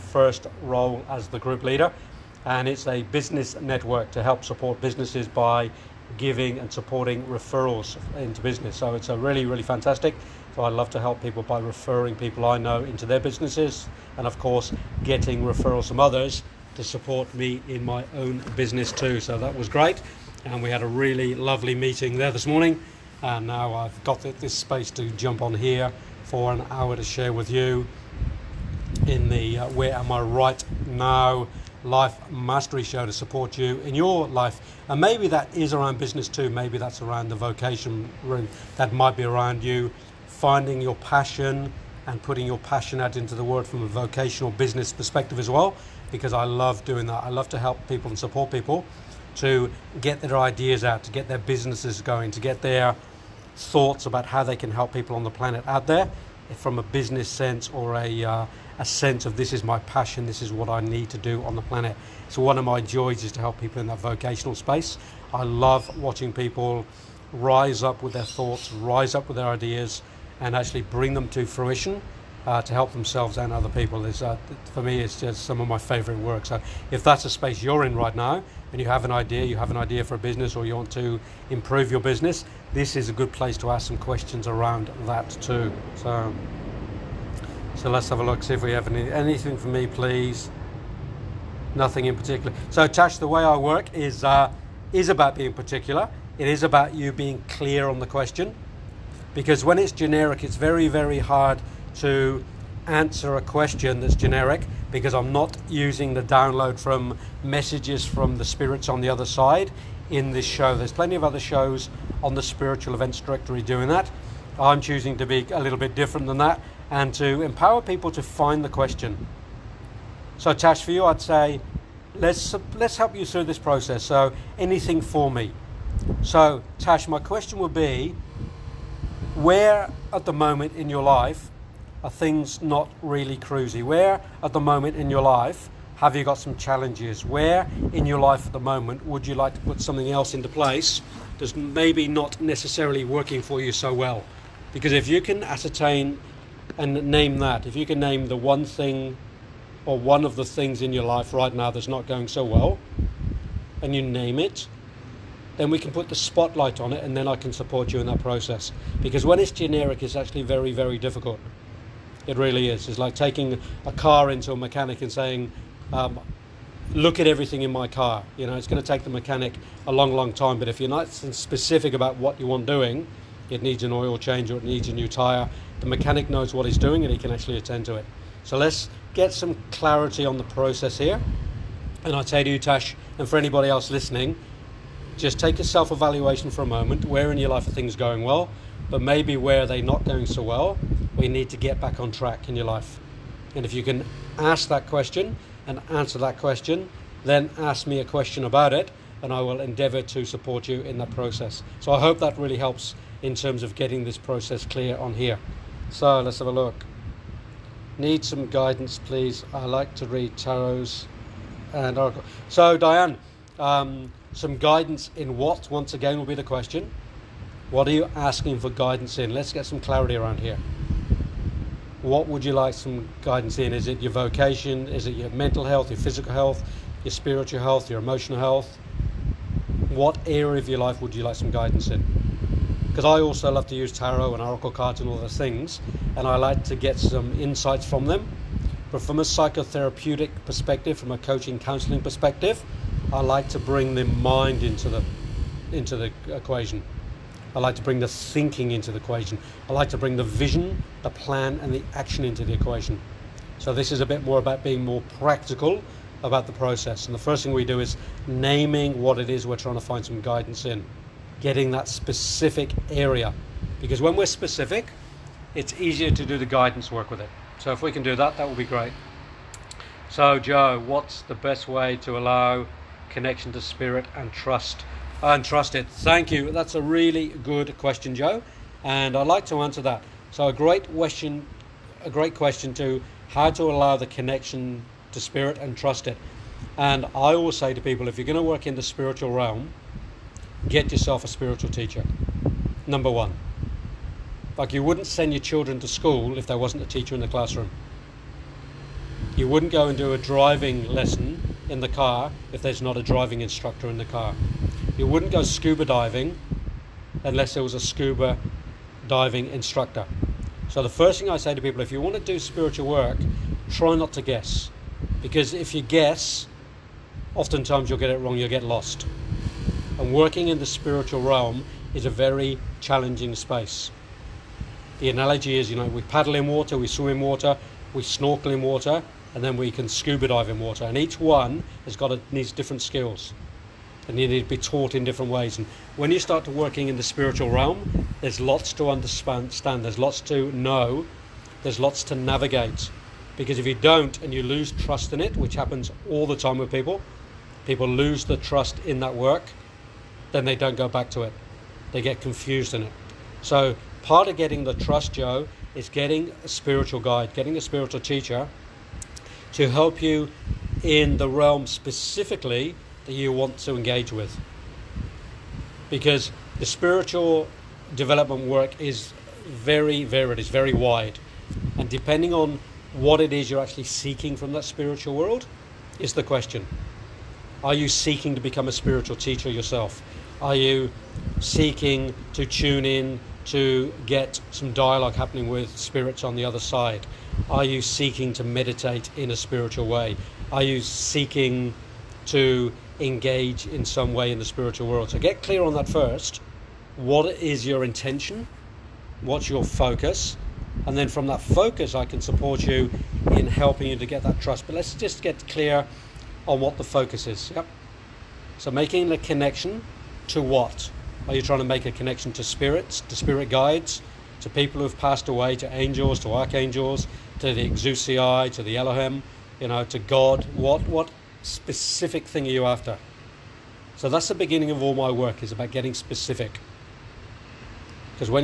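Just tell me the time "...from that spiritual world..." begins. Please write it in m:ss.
6:14.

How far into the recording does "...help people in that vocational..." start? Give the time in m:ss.
1:03.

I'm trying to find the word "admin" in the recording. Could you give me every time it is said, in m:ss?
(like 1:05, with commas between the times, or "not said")
not said.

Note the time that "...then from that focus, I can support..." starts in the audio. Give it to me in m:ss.
6:40.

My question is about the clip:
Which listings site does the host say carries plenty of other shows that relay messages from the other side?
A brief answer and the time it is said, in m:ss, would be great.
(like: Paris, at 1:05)
Spiritual Events Directory, at 1:52.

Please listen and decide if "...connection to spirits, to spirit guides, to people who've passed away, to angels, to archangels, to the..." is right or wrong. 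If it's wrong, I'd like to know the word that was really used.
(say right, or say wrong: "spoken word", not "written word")
right.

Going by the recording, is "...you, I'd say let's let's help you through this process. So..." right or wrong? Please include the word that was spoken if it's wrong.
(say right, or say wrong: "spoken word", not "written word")
right.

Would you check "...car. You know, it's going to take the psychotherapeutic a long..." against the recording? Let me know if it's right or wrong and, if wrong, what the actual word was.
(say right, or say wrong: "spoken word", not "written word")
wrong: "mechanic", not "psychotherapeutic".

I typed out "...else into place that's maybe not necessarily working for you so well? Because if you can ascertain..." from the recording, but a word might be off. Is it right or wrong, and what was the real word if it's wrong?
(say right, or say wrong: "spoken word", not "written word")
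right.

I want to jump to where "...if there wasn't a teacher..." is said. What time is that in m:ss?
4:56.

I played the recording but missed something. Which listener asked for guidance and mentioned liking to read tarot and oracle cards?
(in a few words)
Diane.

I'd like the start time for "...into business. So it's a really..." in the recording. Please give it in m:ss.
0:08.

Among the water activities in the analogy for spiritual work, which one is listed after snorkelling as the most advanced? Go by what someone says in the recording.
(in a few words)
scuba dive.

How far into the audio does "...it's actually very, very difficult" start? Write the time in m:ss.
2:40.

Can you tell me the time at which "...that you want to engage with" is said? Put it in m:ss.
6:03.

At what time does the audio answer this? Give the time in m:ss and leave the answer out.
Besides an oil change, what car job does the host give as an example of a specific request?
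2:54.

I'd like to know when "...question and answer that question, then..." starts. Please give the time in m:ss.
3:14.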